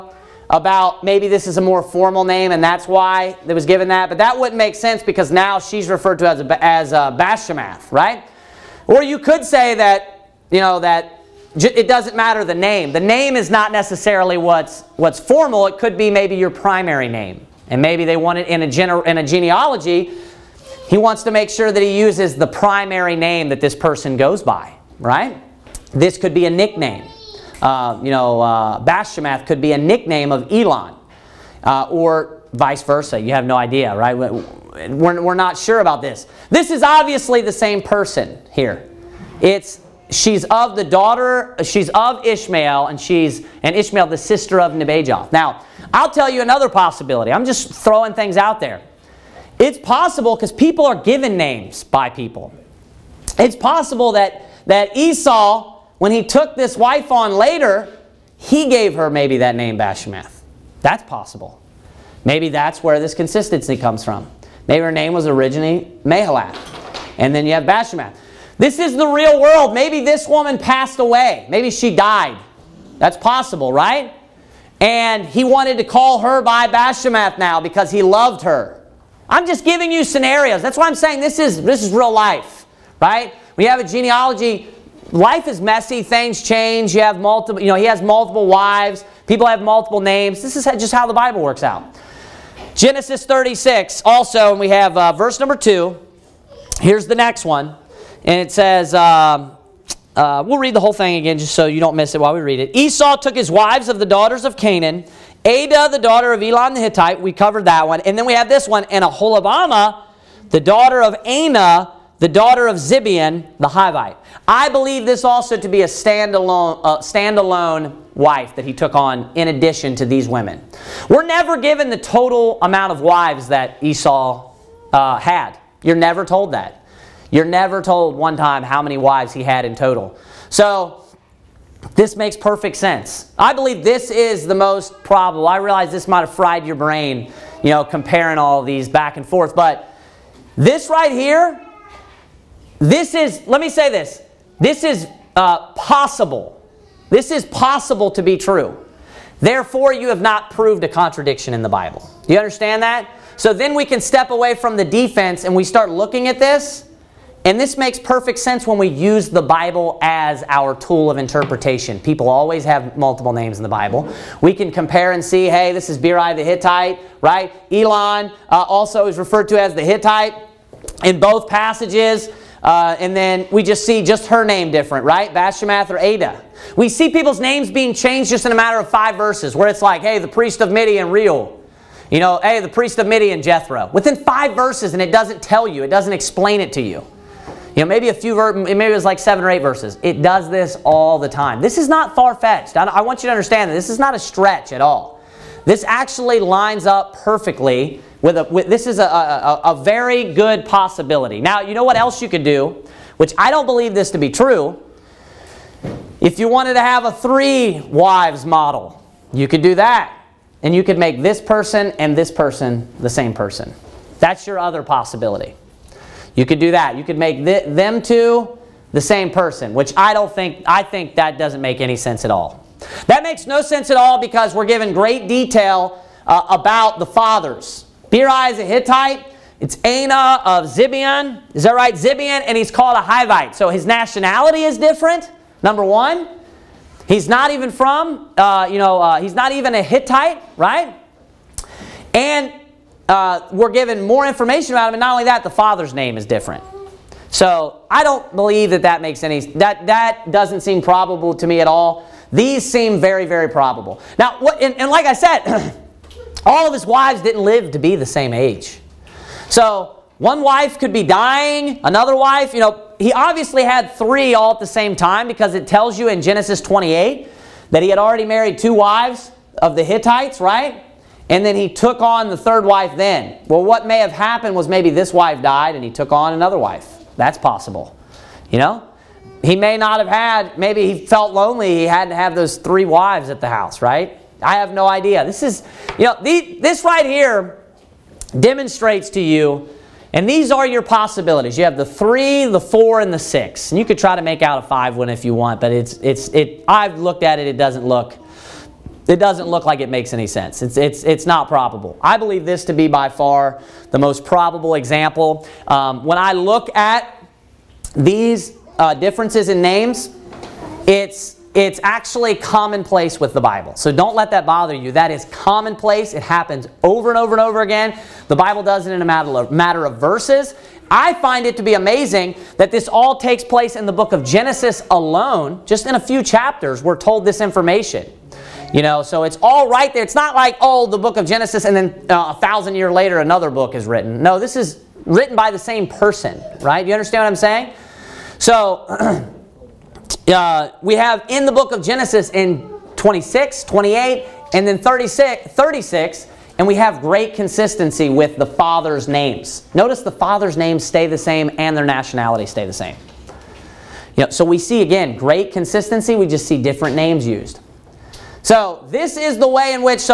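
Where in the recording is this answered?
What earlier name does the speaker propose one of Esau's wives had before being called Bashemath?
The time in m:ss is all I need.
1:06.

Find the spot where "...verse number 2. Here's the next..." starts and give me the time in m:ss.
1:35.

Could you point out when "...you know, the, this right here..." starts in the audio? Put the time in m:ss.
4:45.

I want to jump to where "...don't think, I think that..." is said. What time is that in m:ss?
3:40.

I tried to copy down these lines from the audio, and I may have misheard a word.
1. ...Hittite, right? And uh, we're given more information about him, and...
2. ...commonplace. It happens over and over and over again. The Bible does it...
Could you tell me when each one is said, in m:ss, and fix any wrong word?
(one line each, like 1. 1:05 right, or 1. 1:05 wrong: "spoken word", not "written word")
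1. 3:59 right
2. 5:15 right.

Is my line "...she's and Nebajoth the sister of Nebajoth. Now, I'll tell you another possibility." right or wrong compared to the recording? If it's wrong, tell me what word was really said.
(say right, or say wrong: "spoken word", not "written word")
wrong: "Ishmael", not "Nebajoth".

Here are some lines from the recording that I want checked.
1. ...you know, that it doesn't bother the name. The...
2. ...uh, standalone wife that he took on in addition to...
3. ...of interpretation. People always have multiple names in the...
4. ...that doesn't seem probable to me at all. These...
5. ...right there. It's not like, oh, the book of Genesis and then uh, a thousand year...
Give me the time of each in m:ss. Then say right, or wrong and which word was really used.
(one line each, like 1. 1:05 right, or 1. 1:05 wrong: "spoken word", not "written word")
1. 0:10 wrong: "matter", not "bother"
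2. 1:56 right
3. 2:41 right
4. 4:09 right
5. 5:29 right.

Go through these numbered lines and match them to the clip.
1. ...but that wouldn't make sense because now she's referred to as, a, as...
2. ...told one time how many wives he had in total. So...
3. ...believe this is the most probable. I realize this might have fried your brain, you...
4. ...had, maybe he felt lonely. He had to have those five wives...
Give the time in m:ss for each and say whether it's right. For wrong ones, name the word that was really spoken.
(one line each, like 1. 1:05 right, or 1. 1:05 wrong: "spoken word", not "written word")
1. 0:04 right
2. 2:07 right
3. 2:13 right
4. 4:40 wrong: "three", not "five".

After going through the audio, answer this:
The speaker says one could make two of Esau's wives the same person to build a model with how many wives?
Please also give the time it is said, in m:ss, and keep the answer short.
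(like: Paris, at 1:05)
3, at 3:27.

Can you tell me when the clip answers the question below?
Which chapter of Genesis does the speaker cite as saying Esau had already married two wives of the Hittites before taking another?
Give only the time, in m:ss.
4:26.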